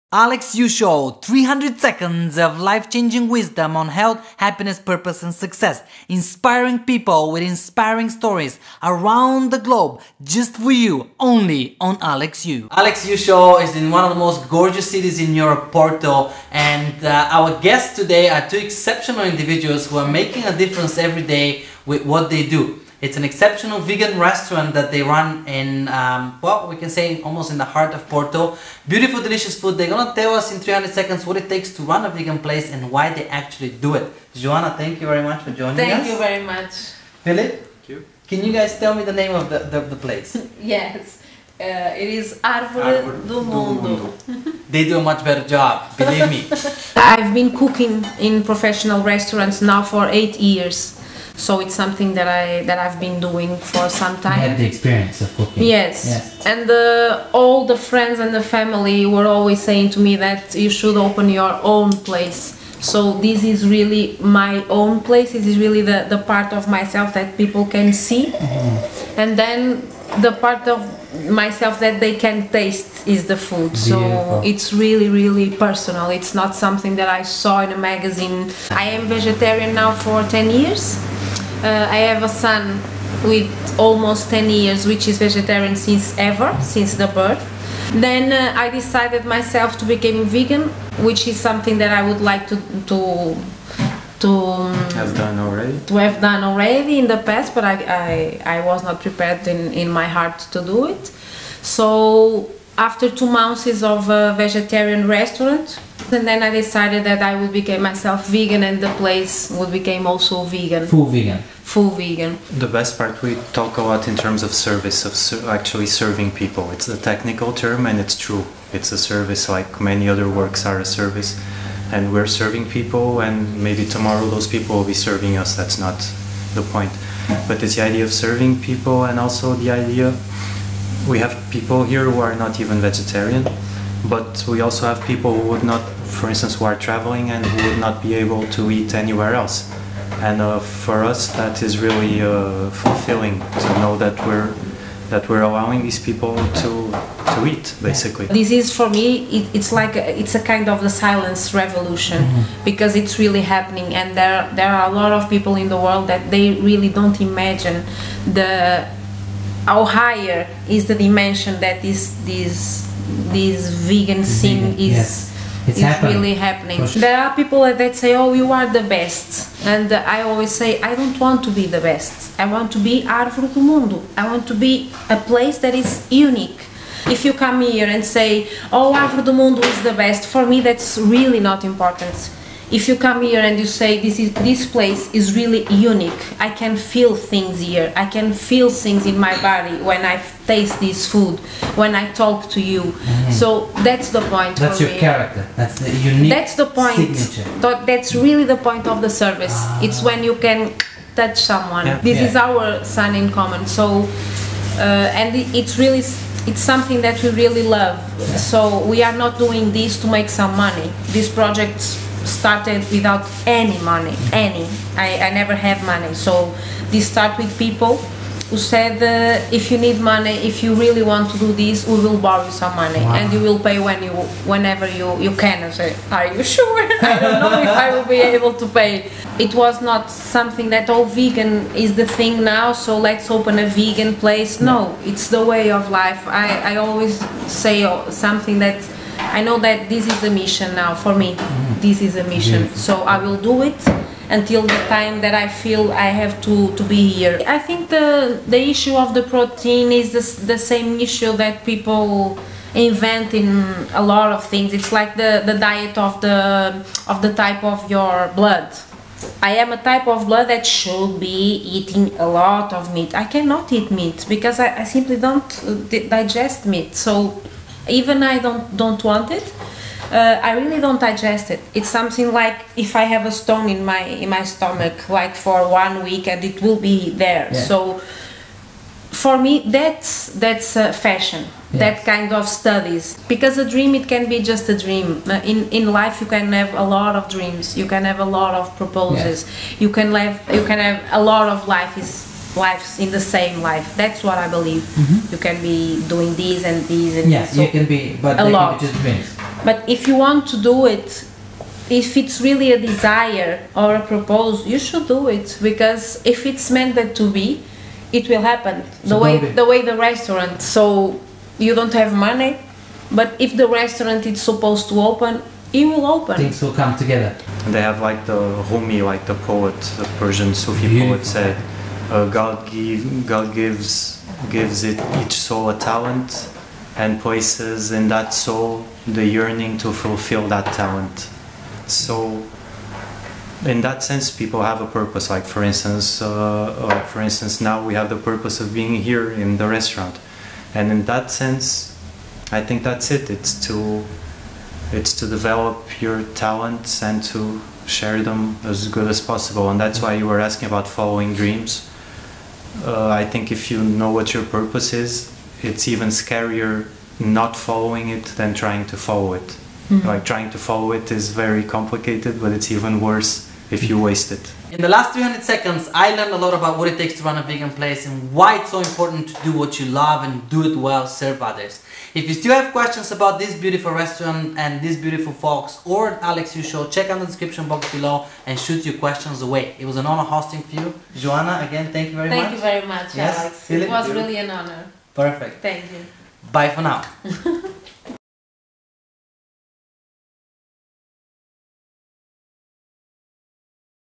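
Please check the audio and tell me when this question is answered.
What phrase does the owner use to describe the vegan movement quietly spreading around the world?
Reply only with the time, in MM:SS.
02:30.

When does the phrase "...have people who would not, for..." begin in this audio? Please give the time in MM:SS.
02:14.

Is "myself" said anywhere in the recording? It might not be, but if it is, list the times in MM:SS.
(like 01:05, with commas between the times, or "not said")
01:06, 01:11, 01:29, 01:47.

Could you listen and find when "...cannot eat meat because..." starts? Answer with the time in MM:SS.
04:23.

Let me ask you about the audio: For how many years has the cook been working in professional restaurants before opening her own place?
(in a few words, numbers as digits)
8.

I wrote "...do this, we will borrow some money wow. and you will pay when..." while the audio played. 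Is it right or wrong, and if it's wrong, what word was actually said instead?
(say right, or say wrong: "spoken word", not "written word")
right.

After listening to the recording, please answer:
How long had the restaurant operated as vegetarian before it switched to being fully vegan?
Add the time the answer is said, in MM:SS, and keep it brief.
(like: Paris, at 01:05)
2 months, at 01:43.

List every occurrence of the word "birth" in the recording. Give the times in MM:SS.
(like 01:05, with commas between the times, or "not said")
01:27.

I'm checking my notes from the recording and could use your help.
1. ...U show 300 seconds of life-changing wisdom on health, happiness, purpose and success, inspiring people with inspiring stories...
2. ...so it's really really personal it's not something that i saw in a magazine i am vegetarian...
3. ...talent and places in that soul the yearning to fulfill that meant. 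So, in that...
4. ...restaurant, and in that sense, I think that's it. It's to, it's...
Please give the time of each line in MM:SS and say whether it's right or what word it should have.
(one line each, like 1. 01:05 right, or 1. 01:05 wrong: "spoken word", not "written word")
1. 00:00 right
2. 01:13 right
3. 05:25 wrong: "talent", not "meant"
4. 05:39 right.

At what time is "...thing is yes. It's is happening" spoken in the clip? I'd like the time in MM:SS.
02:44.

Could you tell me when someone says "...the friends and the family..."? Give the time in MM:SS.
00:57.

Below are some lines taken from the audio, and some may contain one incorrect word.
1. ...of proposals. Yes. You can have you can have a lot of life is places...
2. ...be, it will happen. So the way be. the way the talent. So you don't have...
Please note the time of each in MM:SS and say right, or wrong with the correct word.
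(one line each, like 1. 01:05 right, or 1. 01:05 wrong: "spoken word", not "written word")
1. 04:48 wrong: "lives", not "places"
2. 05:07 wrong: "restaurant", not "talent".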